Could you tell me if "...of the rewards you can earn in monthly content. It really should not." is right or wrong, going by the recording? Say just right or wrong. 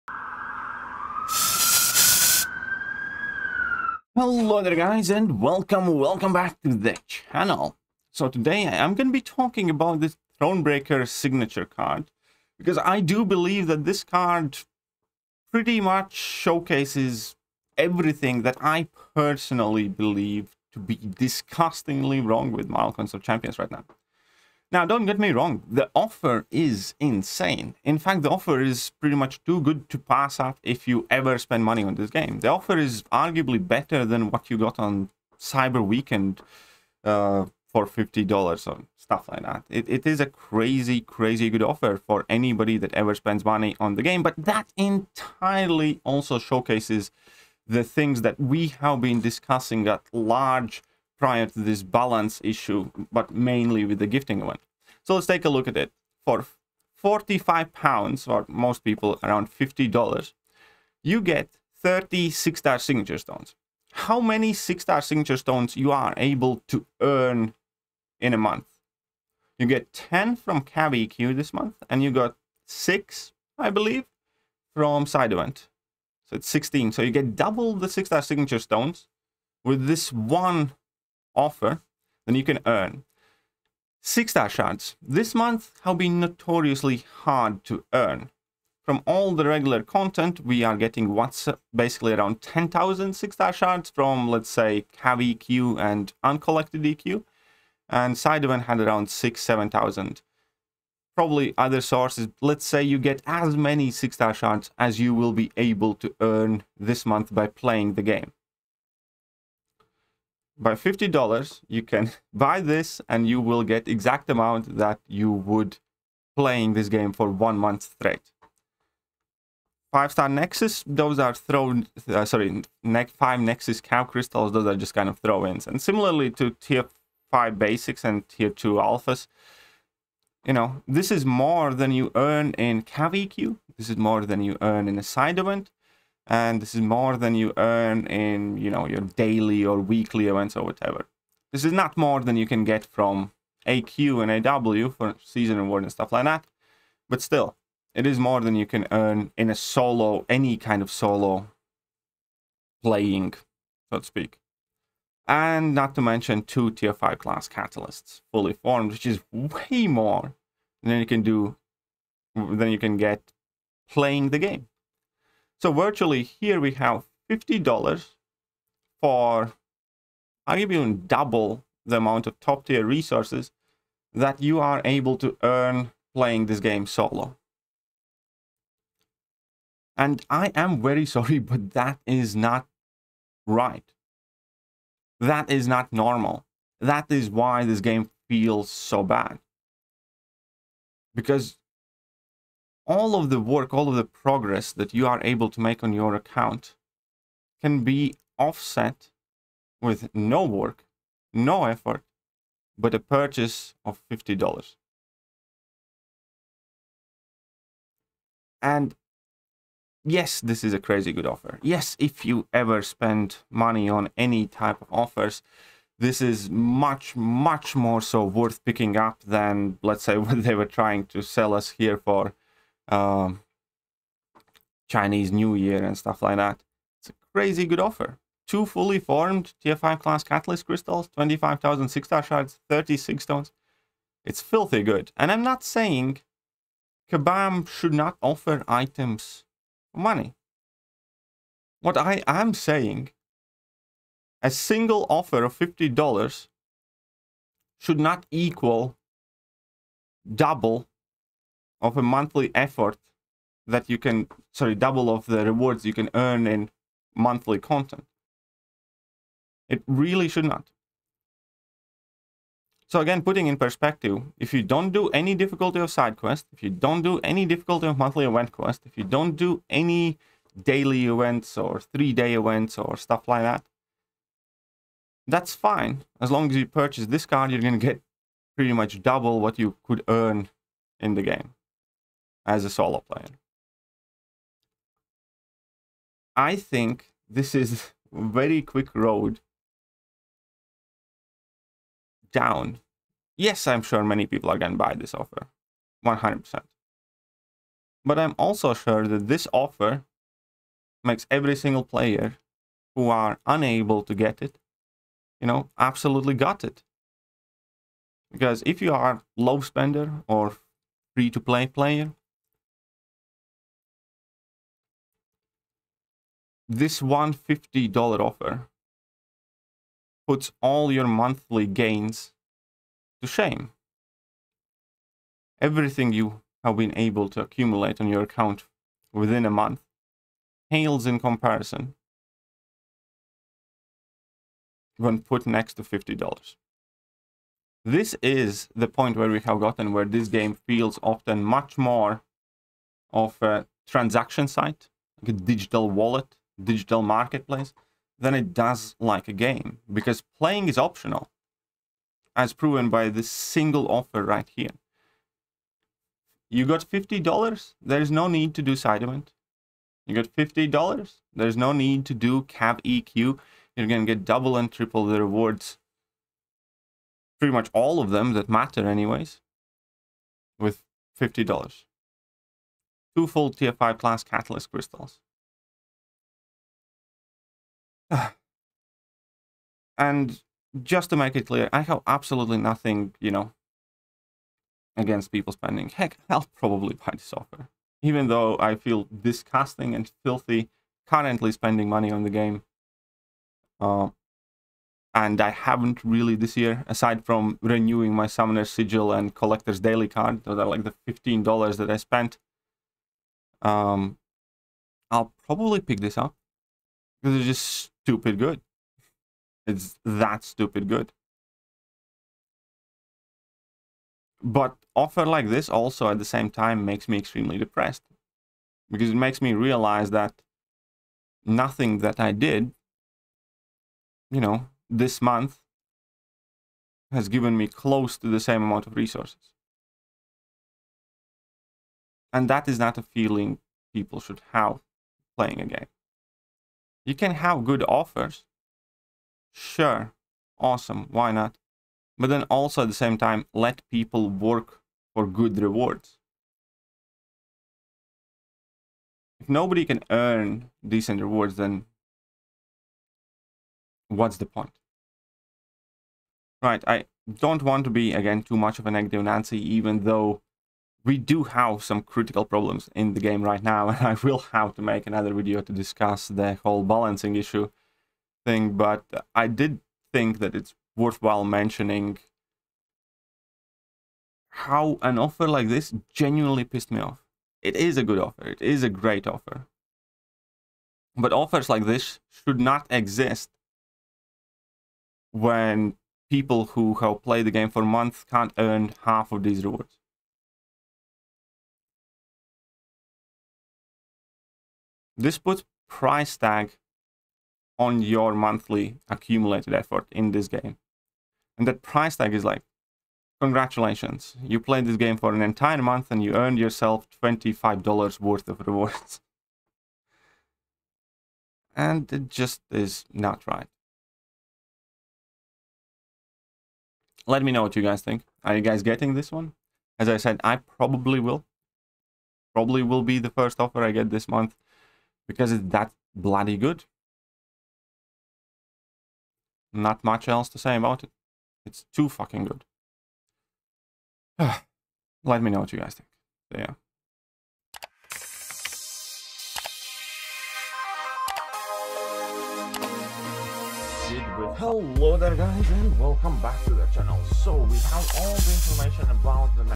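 right.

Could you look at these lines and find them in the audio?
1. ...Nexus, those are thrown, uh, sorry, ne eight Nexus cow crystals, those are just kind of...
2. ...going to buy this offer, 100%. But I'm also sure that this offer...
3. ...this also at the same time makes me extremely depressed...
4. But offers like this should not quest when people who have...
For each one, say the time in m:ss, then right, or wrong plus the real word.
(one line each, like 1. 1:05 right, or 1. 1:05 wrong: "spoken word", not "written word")
1. 2:00 wrong: "five", not "eight"
2. 4:54 right
3. 6:55 right
4. 8:01 wrong: "exist", not "quest".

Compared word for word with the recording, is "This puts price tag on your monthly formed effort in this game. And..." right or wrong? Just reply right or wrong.
wrong.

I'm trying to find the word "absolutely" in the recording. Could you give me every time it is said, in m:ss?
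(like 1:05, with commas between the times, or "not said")
5:05, 6:22.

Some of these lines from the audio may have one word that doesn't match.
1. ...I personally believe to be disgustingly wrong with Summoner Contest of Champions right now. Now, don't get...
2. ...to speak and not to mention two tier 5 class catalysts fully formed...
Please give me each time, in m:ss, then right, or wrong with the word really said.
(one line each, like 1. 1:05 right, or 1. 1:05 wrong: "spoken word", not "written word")
1. 0:18 wrong: "Marvel", not "Summoner"
2. 2:33 right.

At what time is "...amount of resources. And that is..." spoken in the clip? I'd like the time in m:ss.
7:08.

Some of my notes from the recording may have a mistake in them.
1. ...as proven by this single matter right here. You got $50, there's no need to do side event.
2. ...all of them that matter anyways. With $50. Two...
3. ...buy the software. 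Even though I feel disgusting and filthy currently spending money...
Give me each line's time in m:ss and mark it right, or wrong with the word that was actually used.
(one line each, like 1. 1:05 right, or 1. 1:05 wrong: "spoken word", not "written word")
1. 5:52 wrong: "offer", not "matter"
2. 6:07 right
3. 6:26 right.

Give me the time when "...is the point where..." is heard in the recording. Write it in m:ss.
5:38.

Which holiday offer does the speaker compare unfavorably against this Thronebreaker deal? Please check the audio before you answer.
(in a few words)
Chinese New Year.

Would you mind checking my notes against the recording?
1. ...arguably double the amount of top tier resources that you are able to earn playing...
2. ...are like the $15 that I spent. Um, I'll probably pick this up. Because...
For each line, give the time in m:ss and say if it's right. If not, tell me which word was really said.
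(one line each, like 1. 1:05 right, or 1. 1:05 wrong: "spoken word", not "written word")
1. 2:50 right
2. 6:40 right.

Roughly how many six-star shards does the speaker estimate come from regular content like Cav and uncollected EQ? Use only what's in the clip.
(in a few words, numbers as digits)
10,000.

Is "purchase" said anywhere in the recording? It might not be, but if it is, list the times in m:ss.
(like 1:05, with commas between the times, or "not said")
3:22, 4:36.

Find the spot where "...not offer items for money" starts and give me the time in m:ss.
3:57.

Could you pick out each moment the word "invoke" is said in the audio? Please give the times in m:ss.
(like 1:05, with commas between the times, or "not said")
not said.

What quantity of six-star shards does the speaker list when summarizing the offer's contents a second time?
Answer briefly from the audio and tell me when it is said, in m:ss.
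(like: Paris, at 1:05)
25,000, at 3:51.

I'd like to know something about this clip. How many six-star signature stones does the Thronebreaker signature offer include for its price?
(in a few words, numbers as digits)
30.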